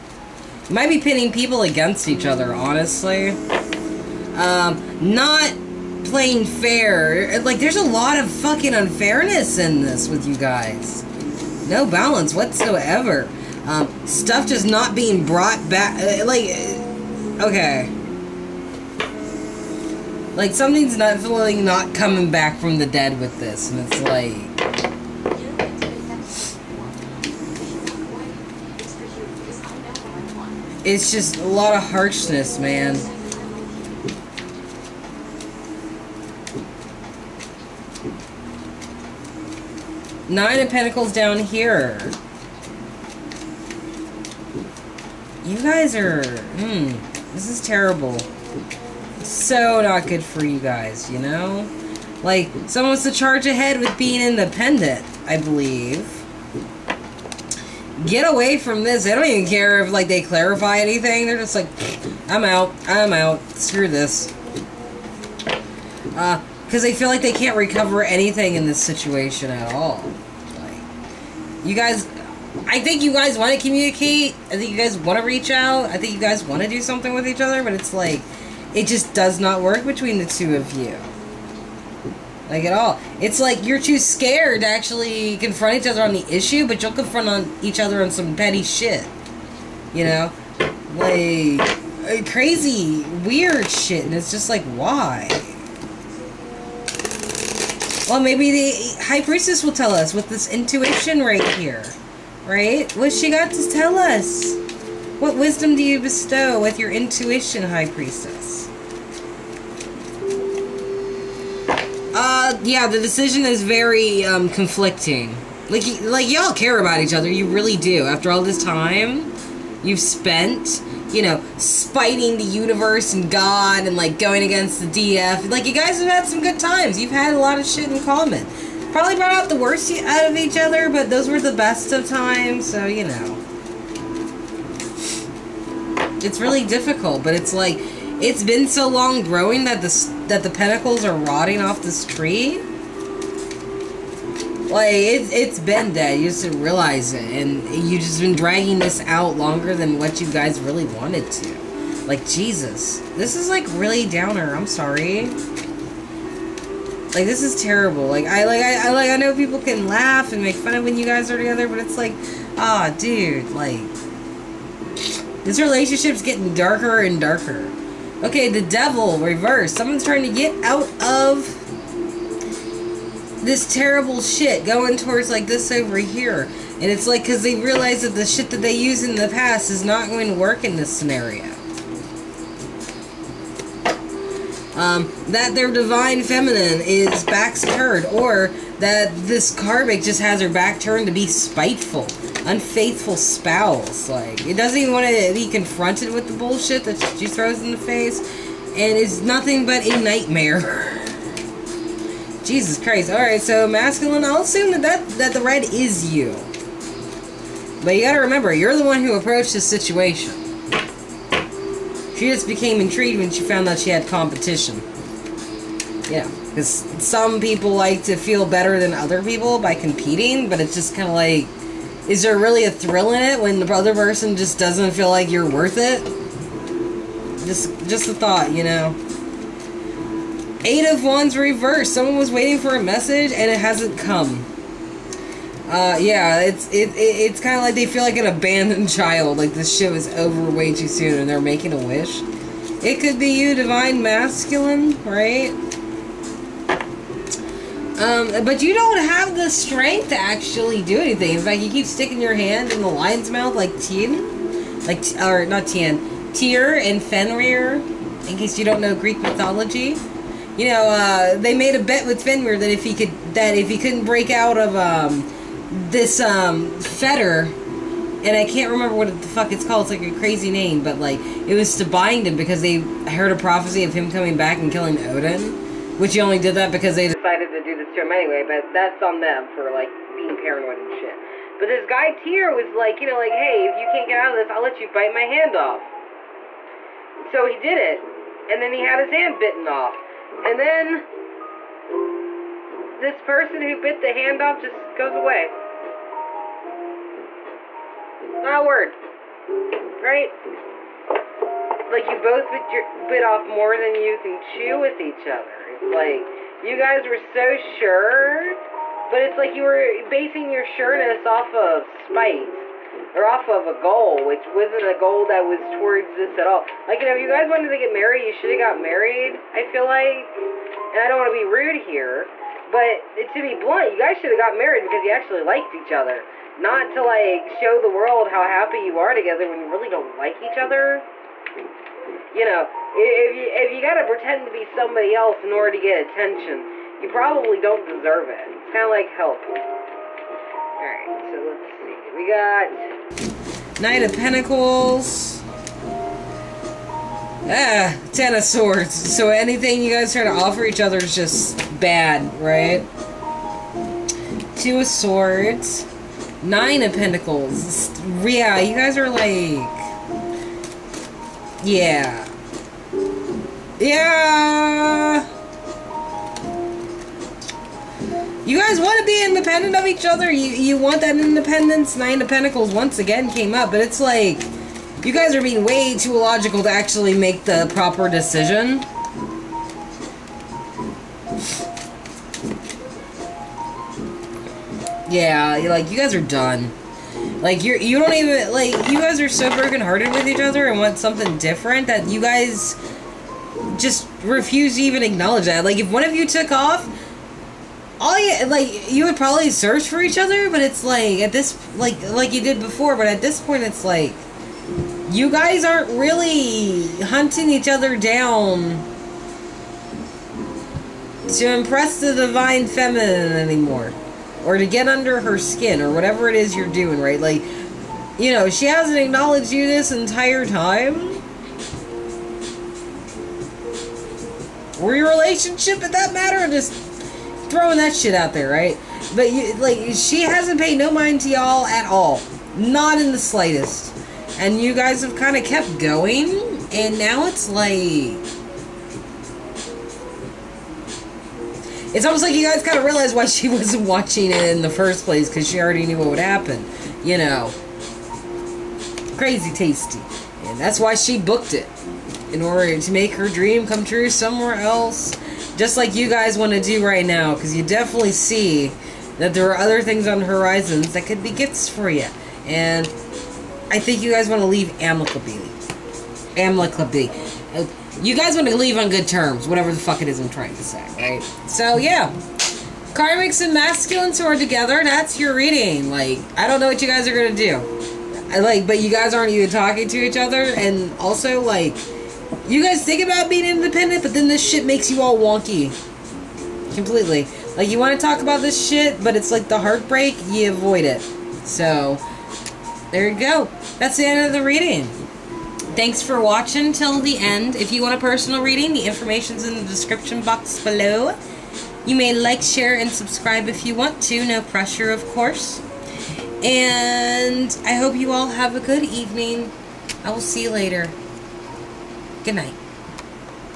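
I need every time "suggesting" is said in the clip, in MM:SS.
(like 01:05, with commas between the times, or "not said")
not said.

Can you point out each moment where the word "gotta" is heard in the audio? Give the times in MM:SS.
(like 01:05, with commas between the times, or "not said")
03:28, 05:33.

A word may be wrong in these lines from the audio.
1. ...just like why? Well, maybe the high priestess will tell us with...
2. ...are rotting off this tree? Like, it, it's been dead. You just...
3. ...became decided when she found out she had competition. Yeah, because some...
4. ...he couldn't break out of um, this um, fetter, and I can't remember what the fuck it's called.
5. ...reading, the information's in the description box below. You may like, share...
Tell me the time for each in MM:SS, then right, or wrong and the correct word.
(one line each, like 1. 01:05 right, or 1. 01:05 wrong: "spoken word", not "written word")
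1. 01:34 right
2. 02:21 right
3. 03:32 wrong: "intrigued", not "decided"
4. 04:23 right
5. 08:18 right.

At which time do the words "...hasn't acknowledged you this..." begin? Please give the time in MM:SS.
06:58.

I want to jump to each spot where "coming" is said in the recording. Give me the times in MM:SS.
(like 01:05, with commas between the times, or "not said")
00:21, 04:34.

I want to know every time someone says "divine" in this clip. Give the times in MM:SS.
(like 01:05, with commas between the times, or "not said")
03:05, 04:03, 06:52.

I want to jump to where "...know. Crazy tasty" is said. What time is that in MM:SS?
07:27.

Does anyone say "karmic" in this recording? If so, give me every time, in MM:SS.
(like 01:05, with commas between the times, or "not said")
03:09, 07:52.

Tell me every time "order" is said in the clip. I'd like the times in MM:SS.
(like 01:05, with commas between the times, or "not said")
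05:35, 07:32.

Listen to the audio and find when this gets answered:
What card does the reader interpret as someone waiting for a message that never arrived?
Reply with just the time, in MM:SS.
03:50.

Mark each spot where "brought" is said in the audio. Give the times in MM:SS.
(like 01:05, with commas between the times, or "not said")
00:15, 02:09.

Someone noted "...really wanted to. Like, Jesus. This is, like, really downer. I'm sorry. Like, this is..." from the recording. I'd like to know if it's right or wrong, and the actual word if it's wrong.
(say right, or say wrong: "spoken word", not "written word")
right.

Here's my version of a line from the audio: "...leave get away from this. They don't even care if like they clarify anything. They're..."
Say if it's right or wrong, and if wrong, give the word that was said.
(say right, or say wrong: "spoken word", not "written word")
wrong: "believe", not "leave".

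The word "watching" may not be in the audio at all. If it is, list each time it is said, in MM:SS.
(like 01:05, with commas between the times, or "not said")
07:23, 08:16.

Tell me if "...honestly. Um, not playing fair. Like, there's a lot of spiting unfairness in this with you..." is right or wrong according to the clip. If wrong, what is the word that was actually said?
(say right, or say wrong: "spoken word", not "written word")
wrong: "fucking", not "spiting".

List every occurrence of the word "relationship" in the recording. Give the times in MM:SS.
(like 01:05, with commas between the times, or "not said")
02:45, 07:05.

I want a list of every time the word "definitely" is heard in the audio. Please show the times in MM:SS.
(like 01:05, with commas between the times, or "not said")
00:20, 07:37.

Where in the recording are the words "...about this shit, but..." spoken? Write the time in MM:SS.
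08:08.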